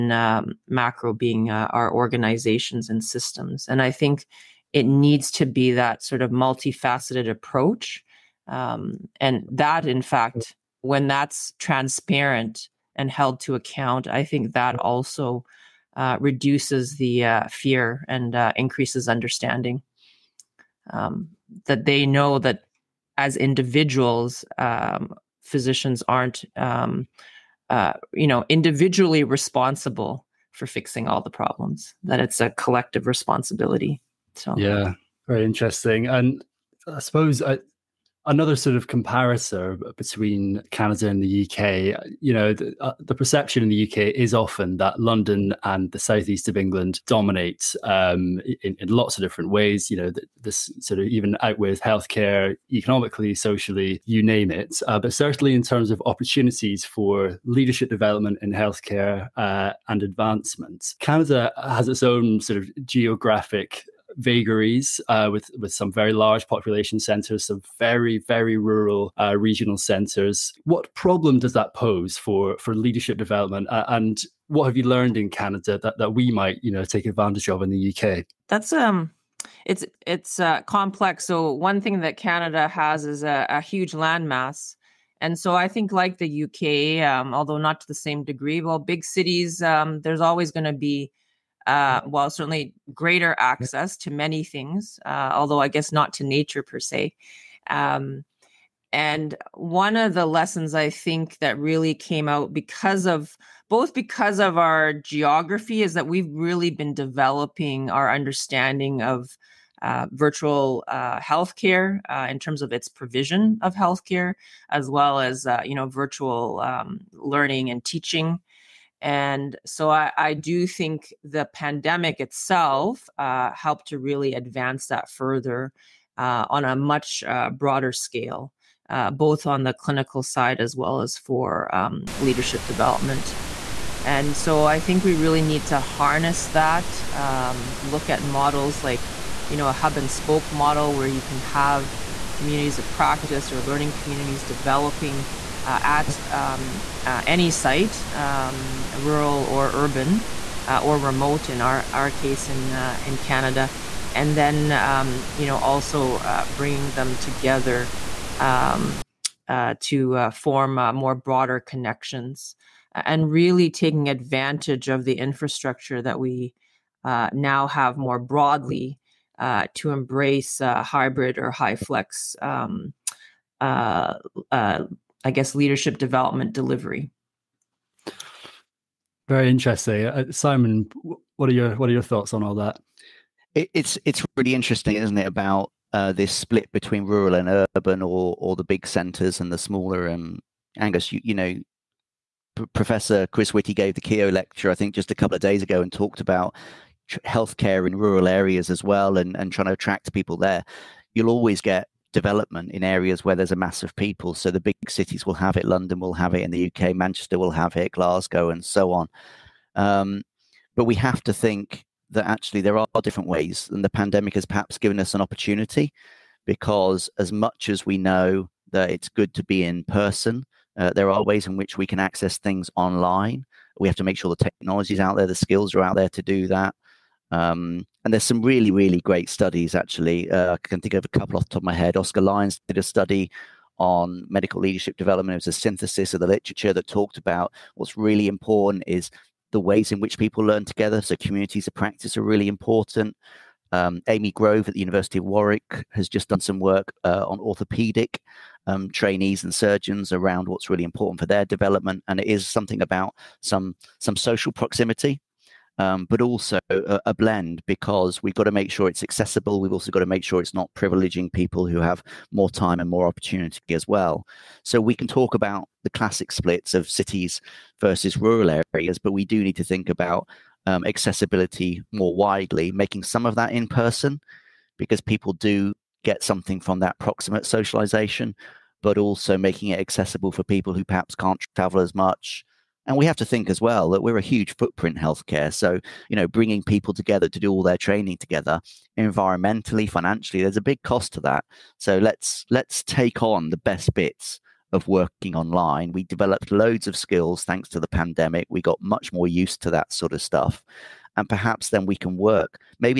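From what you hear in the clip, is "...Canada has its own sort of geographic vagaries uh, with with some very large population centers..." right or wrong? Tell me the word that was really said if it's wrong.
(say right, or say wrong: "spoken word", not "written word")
right.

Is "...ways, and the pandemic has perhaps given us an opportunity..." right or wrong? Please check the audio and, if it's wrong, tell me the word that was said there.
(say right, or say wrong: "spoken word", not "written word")
right.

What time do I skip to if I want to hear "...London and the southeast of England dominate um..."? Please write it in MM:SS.
00:44.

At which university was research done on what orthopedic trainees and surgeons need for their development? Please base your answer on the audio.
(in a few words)
University of Warwick.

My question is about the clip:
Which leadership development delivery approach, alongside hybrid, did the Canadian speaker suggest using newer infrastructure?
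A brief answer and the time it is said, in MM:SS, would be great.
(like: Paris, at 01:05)
HyFlex, at 02:51.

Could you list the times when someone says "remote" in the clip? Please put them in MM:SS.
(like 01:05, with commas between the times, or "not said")
02:30.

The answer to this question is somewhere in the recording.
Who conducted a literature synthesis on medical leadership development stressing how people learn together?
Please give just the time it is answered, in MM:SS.
03:51.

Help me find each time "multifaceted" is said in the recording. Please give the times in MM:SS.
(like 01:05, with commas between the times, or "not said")
00:06.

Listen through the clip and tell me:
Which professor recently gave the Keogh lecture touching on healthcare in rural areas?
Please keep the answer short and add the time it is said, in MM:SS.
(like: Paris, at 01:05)
Chris Whitty, at 03:13.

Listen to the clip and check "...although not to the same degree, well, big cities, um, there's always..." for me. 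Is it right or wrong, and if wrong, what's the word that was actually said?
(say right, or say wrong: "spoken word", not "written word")
right.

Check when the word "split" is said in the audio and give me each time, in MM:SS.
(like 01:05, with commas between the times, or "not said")
03:06, 04:26.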